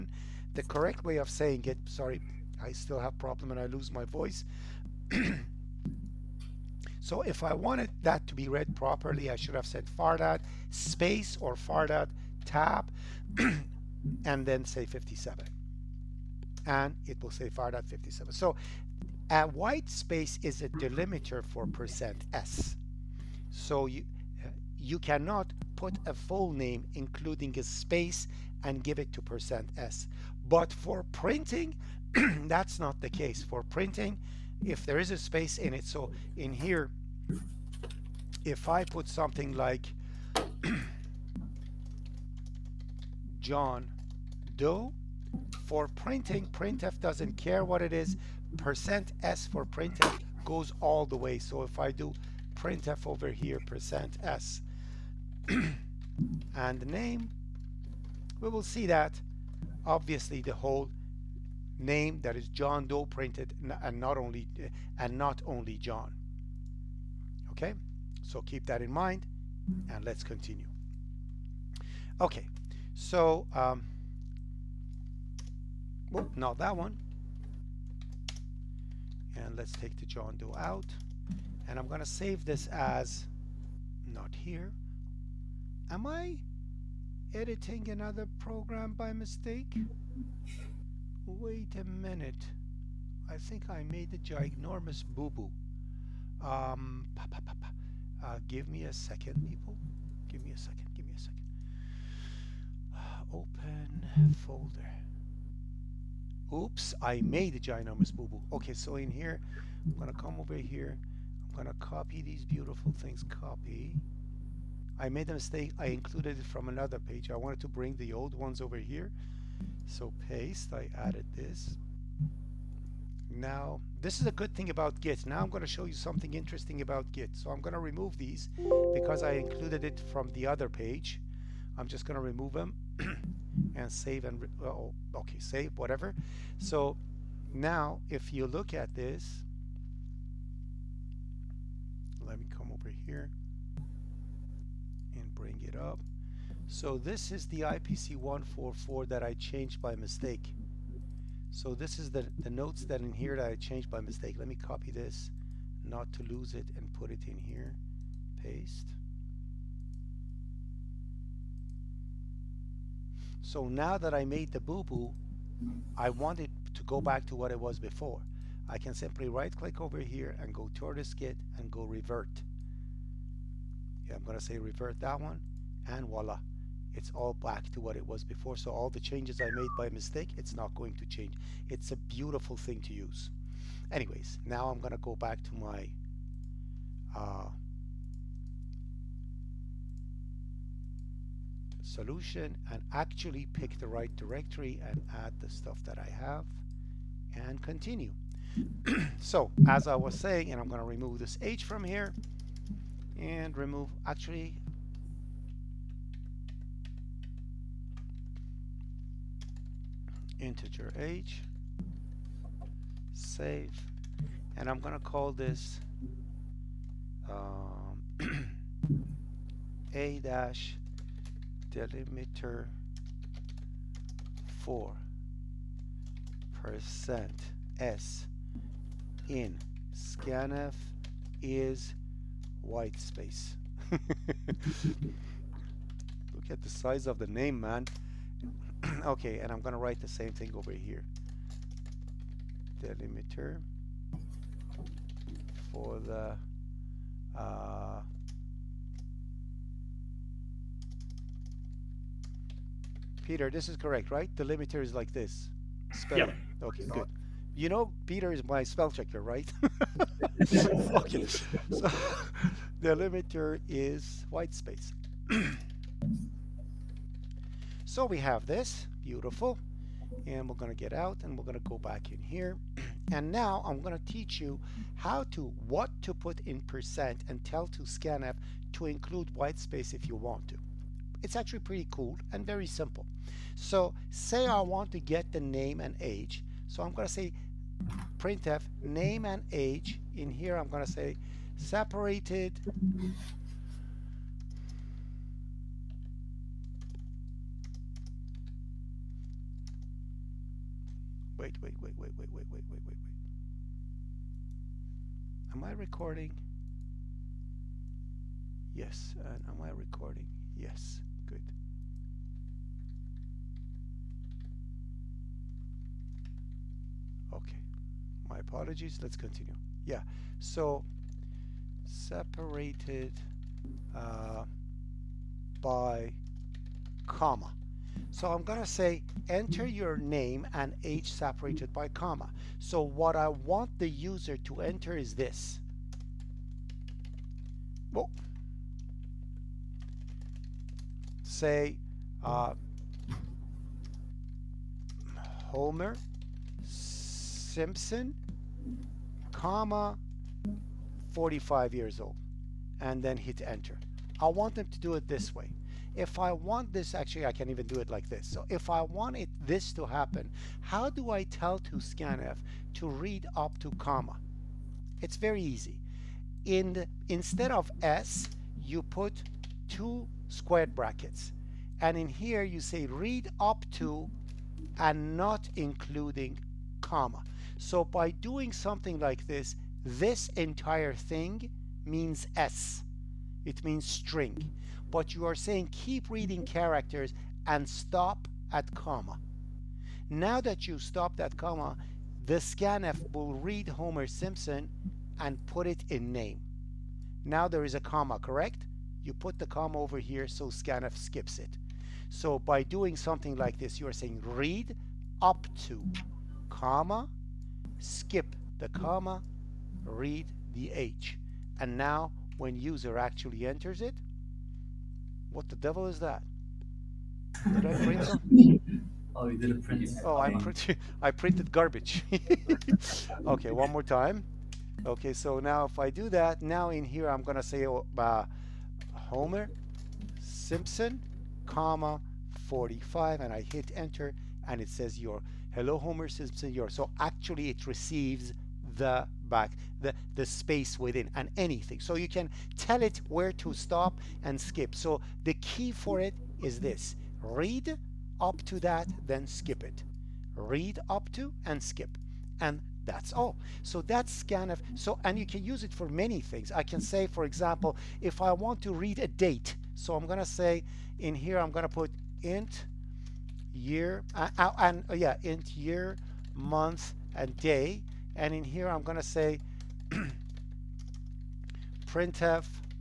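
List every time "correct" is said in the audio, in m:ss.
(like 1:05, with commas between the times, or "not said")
0:00, 4:13, 6:38.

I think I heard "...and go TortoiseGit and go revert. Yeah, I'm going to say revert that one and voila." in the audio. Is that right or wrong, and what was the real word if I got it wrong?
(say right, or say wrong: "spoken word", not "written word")
right.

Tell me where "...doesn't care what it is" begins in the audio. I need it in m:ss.
0:46.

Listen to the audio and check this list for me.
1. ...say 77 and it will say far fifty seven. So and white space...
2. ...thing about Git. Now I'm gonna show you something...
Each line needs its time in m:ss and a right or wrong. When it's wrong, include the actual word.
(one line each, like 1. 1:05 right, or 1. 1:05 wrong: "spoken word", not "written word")
1. 0:14 wrong: "57", not "77"
2. 2:04 right.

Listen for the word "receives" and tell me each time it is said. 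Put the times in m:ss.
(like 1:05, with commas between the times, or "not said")
7:17.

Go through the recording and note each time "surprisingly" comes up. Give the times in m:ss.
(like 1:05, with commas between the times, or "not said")
not said.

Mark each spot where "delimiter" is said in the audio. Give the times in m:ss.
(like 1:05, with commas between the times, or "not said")
0:20, 3:41, 4:02.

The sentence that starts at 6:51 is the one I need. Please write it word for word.
And now when user actually enters it, what the devil is that?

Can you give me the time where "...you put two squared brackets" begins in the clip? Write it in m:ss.
6:08.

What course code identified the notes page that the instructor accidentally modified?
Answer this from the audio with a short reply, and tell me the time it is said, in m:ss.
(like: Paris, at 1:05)
IPC 144, at 2:27.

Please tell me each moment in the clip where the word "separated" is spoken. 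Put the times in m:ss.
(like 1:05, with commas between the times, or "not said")
4:51, 5:21, 5:31.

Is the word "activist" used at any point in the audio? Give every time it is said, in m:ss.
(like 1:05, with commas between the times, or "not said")
not said.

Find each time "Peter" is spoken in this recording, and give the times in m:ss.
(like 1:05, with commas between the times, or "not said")
4:13, 4:18.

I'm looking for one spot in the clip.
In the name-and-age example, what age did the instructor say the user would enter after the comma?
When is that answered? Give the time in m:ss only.
5:51.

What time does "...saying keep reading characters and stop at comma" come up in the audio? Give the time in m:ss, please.
6:25.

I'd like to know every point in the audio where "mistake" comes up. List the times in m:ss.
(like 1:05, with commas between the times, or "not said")
1:29, 1:55, 2:29, 2:34, 2:59.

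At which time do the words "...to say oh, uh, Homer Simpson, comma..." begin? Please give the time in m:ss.
7:07.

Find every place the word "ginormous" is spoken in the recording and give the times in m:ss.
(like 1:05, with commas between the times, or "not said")
1:34, 1:47.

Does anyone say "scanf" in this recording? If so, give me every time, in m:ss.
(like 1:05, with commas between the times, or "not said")
3:49, 4:37, 6:01, 6:32, 6:40, 7:34.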